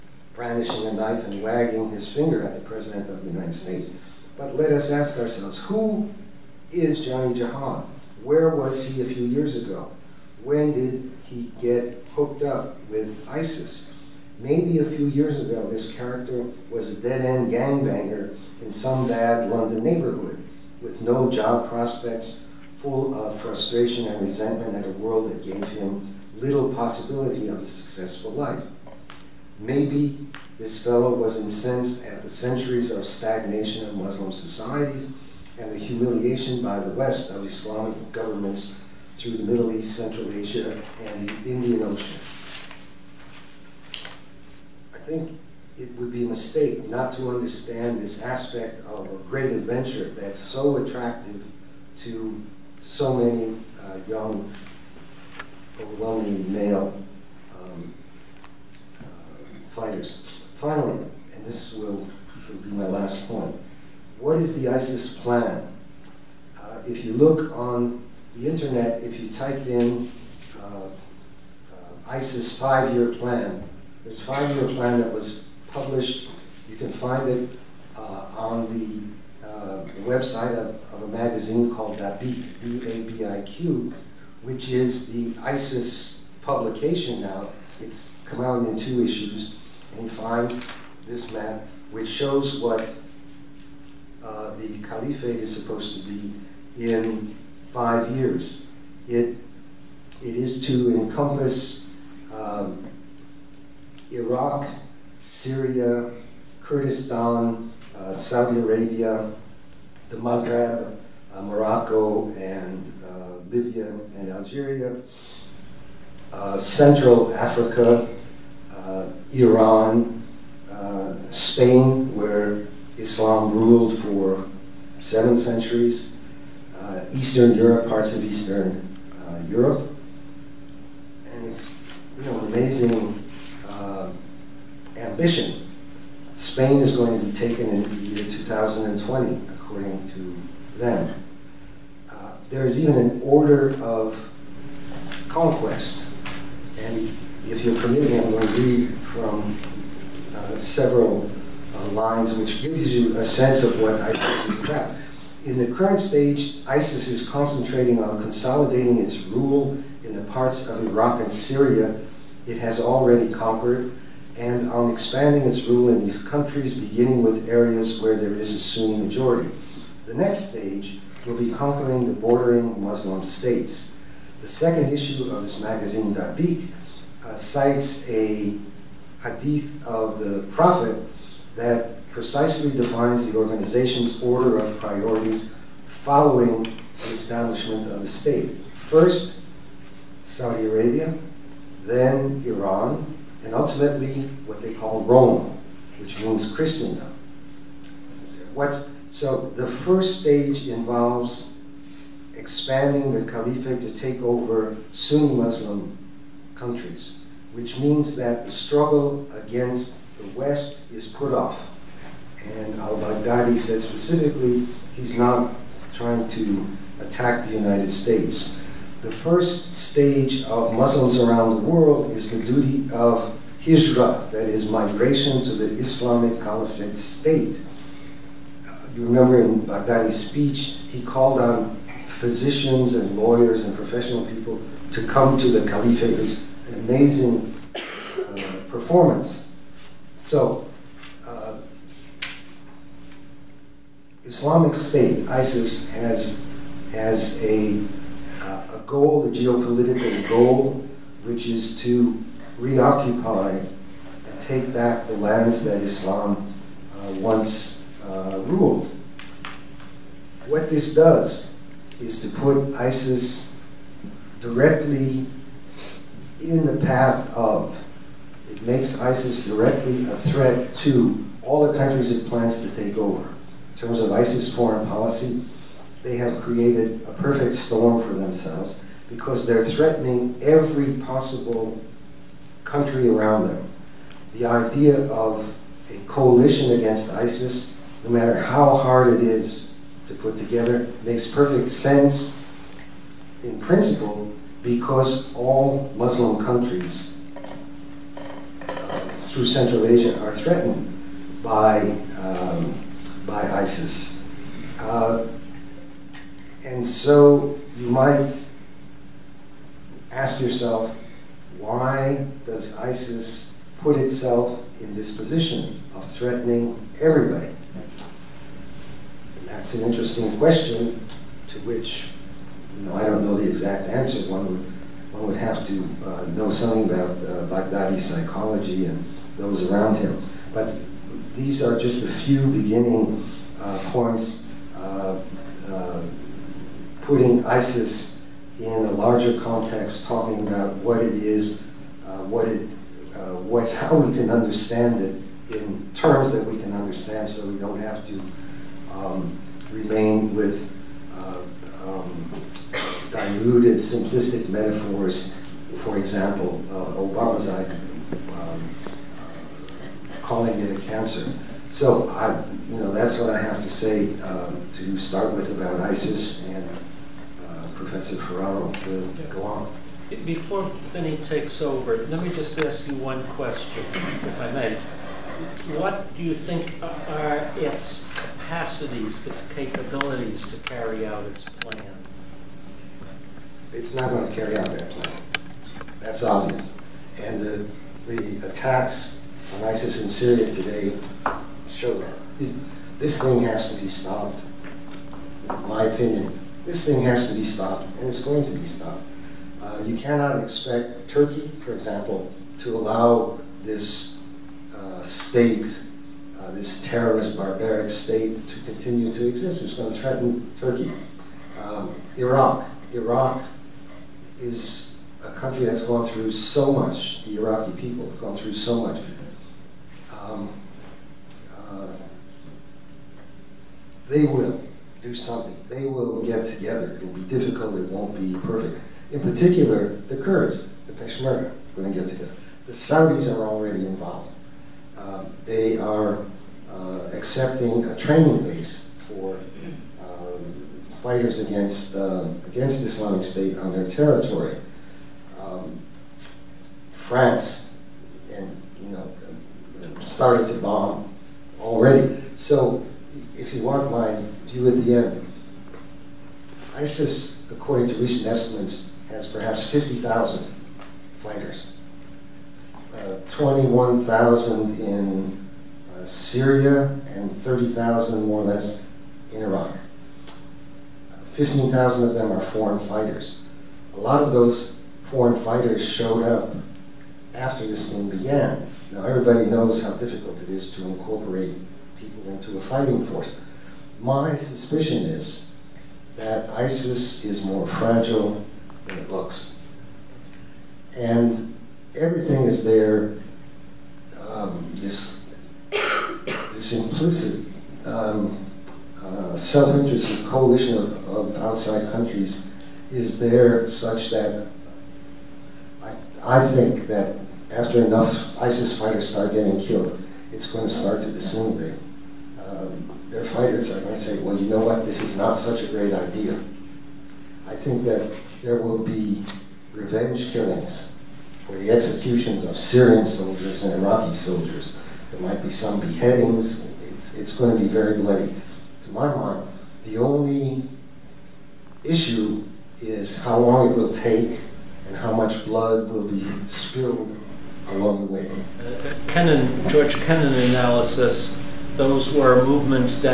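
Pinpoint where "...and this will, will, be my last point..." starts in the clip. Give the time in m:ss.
1:01.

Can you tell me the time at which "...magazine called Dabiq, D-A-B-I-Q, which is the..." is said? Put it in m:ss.
1:21.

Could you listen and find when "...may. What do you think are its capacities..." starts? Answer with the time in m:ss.
6:14.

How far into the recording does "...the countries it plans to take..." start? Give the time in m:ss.
4:31.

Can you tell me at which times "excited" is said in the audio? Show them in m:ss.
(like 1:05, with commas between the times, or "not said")
not said.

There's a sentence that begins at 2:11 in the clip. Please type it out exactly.
And it's you know, amazing ambition.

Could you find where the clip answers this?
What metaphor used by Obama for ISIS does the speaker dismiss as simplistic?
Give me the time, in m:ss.
6:00.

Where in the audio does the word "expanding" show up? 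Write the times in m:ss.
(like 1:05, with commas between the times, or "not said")
2:44, 3:22.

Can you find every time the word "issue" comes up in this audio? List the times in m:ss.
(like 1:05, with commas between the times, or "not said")
1:29, 2:54, 8:51.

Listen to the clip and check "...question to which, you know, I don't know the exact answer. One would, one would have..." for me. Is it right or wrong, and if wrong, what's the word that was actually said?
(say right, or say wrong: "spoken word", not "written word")
right.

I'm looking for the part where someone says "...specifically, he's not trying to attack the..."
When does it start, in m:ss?
3:33.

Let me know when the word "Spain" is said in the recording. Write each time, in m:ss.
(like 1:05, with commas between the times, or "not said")
2:01, 2:16.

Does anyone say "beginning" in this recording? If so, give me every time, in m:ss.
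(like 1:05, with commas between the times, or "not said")
2:46, 5:32.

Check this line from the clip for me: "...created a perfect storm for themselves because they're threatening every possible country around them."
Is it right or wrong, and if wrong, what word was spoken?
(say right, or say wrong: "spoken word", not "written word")
right.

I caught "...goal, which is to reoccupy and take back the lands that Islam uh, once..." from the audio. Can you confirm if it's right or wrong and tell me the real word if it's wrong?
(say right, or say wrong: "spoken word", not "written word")
right.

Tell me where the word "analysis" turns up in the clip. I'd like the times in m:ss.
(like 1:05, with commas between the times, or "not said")
9:00.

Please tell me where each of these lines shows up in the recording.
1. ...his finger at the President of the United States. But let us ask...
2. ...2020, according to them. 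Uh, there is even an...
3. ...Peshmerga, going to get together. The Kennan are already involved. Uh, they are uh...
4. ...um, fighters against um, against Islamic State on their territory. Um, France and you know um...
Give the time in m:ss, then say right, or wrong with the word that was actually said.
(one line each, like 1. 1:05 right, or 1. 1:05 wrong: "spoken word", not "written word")
1. 0:01 right
2. 2:18 right
3. 7:10 wrong: "Saudis", not "Kennan"
4. 7:20 right.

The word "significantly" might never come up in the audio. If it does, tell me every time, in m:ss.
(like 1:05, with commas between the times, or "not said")
not said.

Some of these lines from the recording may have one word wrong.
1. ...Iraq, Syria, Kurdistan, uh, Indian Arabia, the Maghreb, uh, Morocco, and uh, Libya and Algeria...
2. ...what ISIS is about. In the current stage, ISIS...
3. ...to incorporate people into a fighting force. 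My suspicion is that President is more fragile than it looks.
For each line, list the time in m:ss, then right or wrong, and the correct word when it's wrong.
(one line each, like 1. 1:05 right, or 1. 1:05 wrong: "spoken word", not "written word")
1. 1:44 wrong: "Saudi", not "Indian"
2. 2:33 right
3. 8:00 wrong: "ISIS", not "President".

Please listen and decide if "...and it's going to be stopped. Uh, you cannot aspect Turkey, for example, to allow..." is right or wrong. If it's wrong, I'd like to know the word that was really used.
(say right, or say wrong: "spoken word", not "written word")
wrong: "expect", not "aspect".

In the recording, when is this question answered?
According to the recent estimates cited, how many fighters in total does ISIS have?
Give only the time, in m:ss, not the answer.
7:39.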